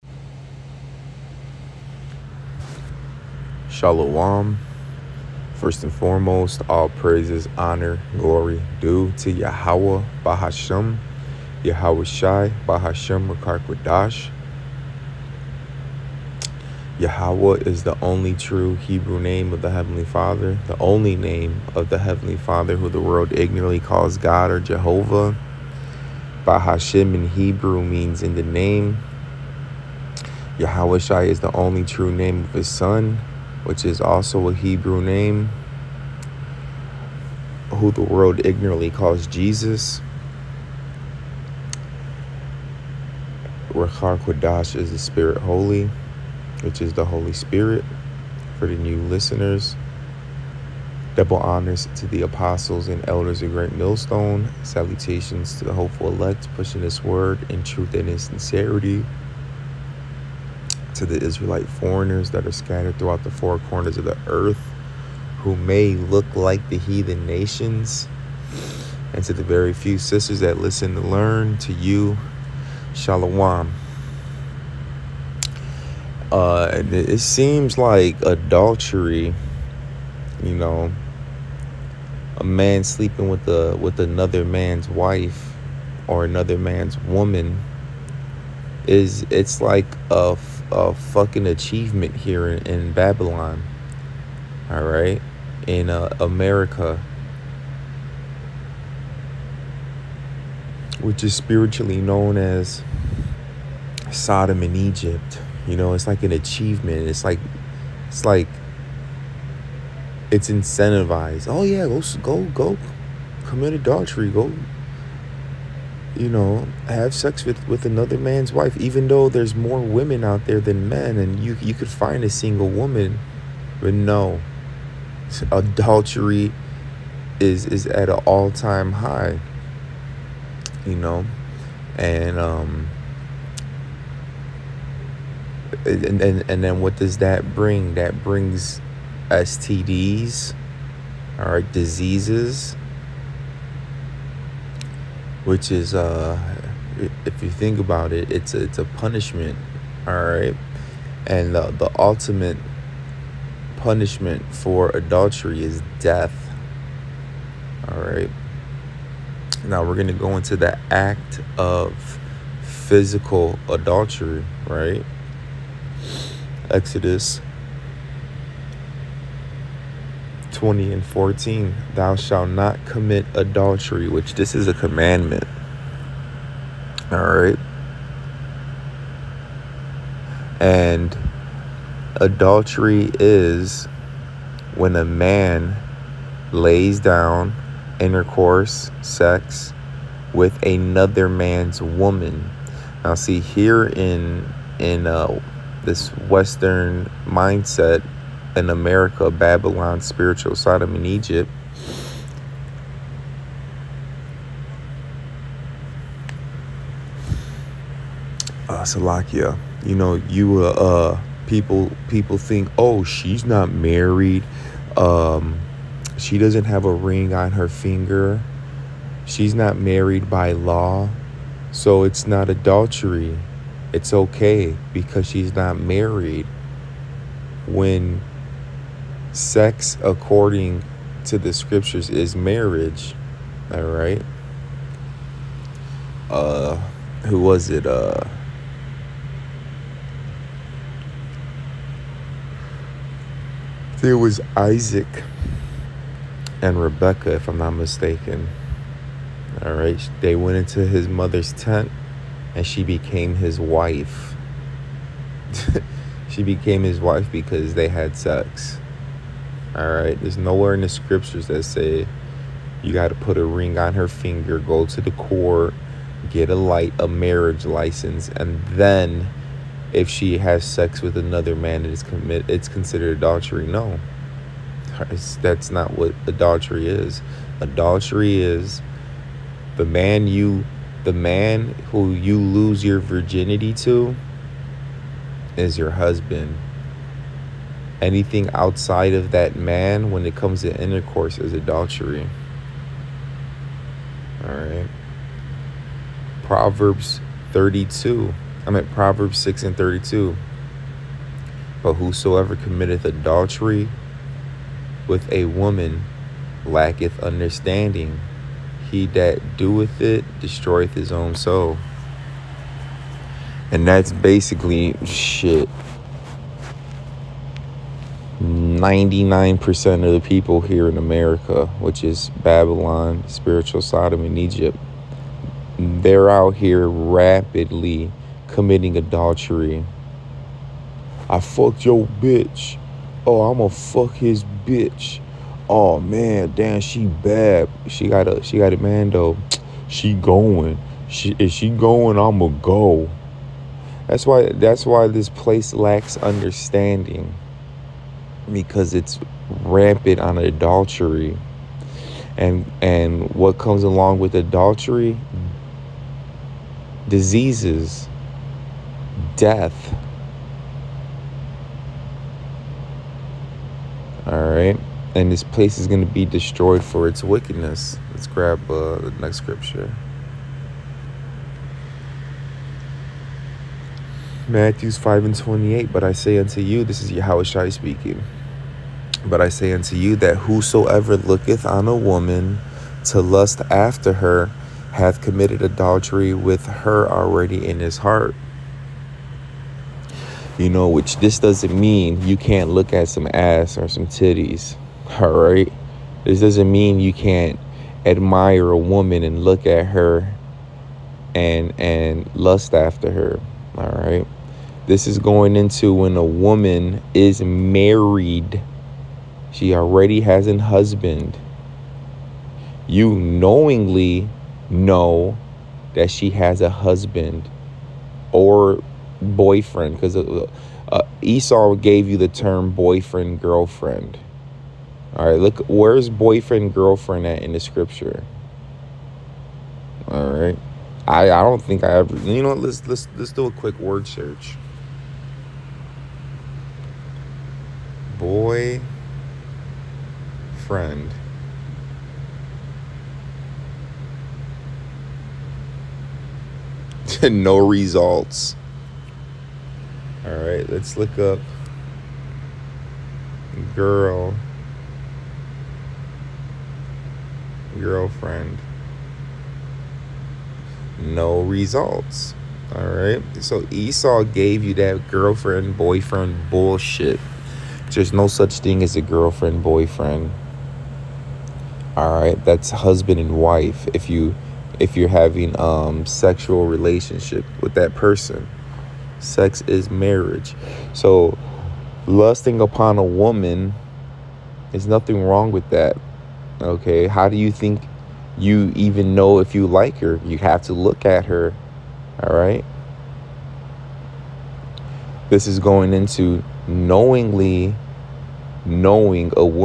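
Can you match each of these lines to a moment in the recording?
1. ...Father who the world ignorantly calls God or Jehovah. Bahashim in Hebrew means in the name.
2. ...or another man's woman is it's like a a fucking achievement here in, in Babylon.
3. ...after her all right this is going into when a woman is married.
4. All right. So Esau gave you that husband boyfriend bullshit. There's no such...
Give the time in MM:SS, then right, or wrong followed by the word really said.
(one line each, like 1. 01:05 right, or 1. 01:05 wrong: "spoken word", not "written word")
1. 00:22 right
2. 01:26 right
3. 06:42 right
4. 07:42 wrong: "girlfriend", not "husband".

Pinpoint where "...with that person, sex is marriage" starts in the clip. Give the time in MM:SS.
07:57.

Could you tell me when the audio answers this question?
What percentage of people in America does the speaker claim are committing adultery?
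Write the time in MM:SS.
05:18.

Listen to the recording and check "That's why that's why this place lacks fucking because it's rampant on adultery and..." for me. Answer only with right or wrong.
wrong.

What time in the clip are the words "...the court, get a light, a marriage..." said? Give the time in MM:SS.
04:24.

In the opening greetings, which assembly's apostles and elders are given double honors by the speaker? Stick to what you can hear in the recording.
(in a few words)
Great Millstone.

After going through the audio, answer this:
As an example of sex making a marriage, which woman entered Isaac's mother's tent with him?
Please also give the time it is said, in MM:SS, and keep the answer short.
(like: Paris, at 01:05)
Rebecca, at 04:06.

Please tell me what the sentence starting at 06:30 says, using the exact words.
You know, which this doesn't mean you can't look at some ass or some titties, all right?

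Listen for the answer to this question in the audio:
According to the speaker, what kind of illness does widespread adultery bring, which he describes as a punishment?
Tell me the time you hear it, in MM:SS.
02:19.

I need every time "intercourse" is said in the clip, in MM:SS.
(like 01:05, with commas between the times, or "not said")
03:07, 04:50.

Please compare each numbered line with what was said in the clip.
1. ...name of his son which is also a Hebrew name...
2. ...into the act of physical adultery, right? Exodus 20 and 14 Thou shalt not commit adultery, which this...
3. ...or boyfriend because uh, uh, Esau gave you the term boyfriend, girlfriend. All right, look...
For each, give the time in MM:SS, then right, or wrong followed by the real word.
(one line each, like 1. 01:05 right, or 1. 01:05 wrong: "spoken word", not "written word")
1. 00:32 right
2. 02:40 right
3. 06:58 right.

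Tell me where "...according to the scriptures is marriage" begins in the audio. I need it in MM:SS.
03:50.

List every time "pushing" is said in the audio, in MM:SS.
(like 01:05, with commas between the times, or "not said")
00:56.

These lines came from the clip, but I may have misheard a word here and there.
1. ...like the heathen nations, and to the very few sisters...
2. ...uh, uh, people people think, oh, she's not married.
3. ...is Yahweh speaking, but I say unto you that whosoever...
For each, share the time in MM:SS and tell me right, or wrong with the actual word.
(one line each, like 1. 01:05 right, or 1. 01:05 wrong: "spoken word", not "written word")
1. 01:06 right
2. 03:30 right
3. 06:17 right.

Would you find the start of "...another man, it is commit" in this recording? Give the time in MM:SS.
04:31.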